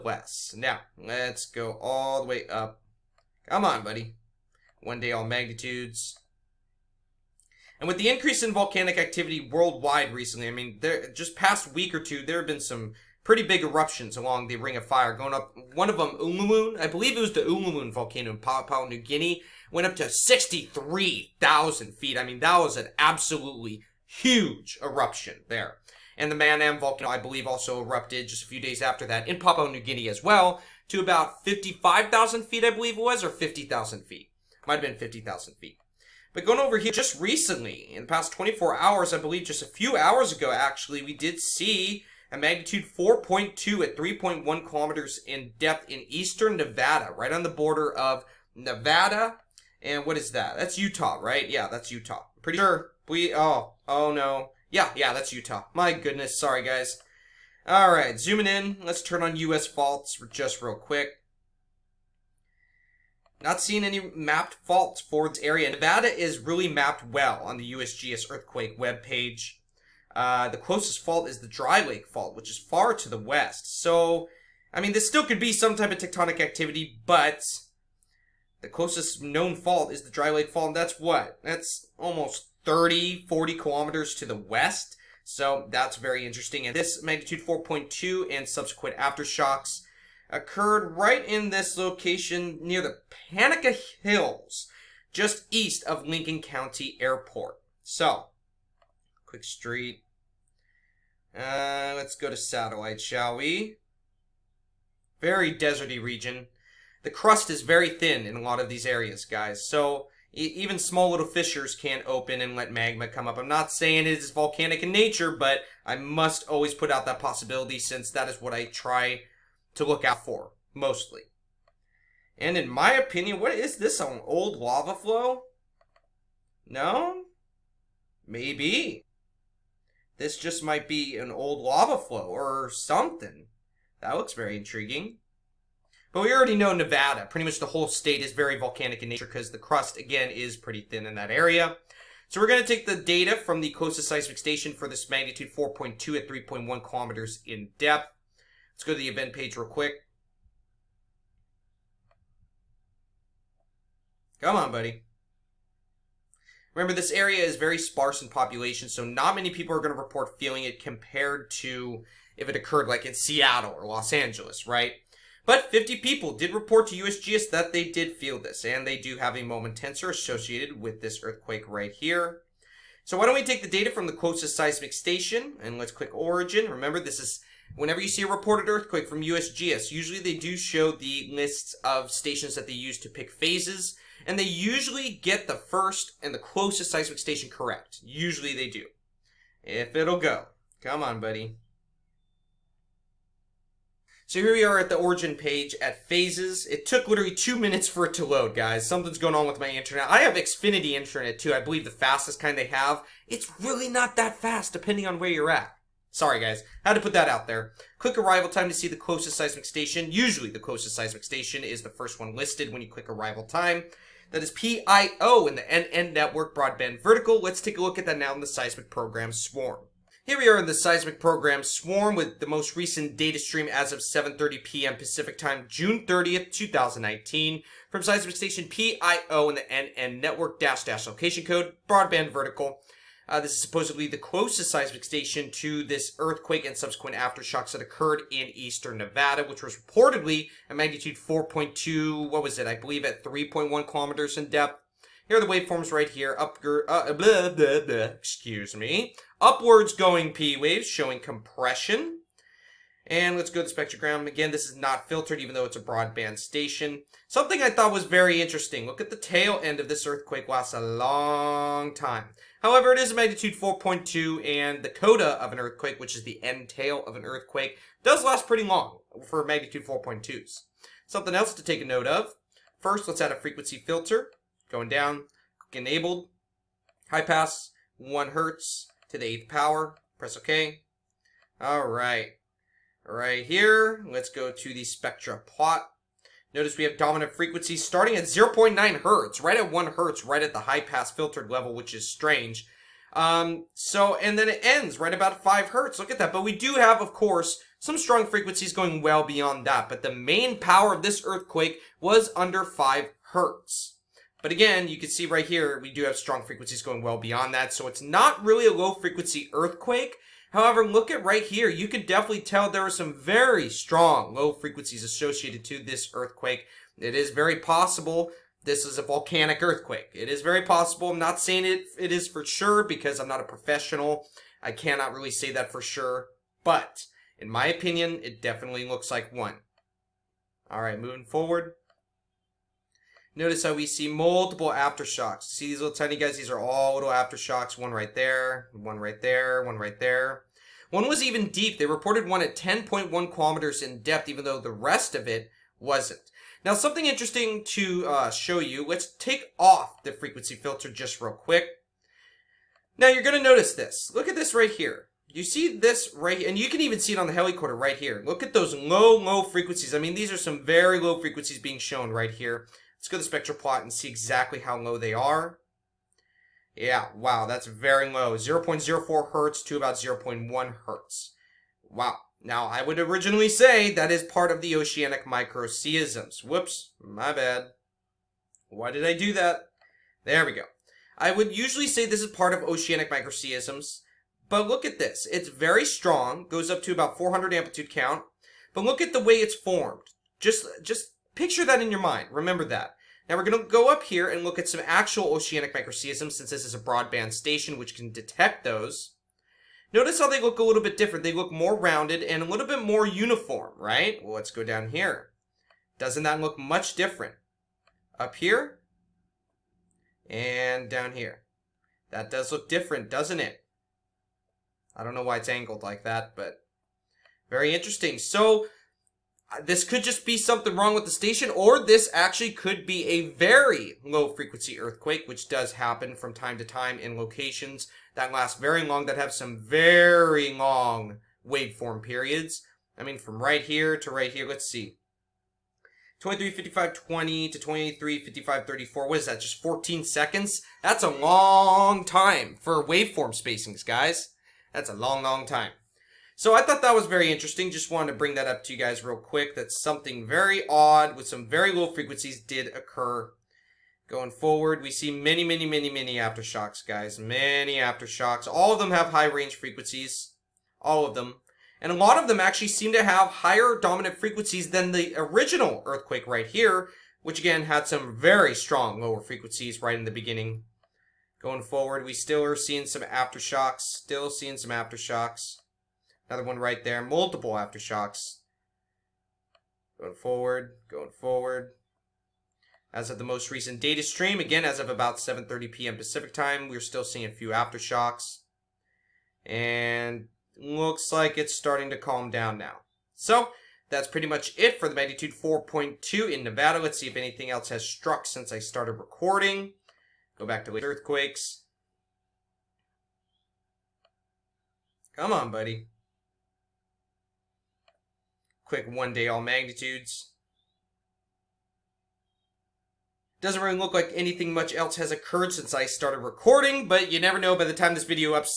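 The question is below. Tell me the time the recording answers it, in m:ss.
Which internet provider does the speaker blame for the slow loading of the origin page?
3:20.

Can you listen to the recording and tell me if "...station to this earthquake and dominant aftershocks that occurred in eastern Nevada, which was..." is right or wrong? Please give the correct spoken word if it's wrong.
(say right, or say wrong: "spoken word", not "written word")
wrong: "subsequent", not "dominant".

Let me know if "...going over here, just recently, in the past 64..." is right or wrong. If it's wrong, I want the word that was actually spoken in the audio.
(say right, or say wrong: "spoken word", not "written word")
wrong: "24", not "64".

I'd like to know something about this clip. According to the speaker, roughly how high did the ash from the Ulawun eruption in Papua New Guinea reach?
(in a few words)
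63,000 feet.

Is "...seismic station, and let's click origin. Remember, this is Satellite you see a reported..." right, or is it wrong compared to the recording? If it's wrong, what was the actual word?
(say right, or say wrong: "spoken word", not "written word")
wrong: "Whenever", not "Satellite".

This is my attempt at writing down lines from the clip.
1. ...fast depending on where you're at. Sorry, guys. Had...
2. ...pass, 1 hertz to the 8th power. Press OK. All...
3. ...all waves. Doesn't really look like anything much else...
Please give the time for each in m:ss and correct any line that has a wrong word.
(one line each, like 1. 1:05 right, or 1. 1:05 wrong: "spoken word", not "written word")
1. 3:24 right
2. 4:37 right
3. 8:29 wrong: "magnitudes", not "waves".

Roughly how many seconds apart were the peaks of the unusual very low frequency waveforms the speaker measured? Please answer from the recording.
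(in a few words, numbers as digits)
14 seconds.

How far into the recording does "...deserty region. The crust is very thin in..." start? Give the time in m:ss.
1:45.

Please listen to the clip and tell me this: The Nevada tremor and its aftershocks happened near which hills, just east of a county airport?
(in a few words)
Panaca Hills.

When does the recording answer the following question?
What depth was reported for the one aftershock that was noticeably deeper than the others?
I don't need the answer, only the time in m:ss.
5:42.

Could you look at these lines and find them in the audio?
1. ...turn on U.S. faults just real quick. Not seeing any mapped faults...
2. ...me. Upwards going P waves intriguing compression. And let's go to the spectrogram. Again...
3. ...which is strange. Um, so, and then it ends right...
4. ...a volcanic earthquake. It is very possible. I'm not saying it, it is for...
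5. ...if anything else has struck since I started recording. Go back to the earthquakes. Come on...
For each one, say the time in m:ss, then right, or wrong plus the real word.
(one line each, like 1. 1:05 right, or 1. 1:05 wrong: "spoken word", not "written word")
1. 0:59 right
2. 4:08 wrong: "showing", not "intriguing"
3. 4:51 right
4. 5:18 right
5. 8:17 right.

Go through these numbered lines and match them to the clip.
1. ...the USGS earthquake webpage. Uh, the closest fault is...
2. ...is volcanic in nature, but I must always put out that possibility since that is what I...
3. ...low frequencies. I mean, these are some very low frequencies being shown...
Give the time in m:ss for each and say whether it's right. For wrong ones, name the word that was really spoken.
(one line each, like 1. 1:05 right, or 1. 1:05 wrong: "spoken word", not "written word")
1. 1:07 right
2. 1:54 right
3. 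5:59 right.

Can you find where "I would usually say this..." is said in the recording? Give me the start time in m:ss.
6:21.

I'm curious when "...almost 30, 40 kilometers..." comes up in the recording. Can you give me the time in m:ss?
1:21.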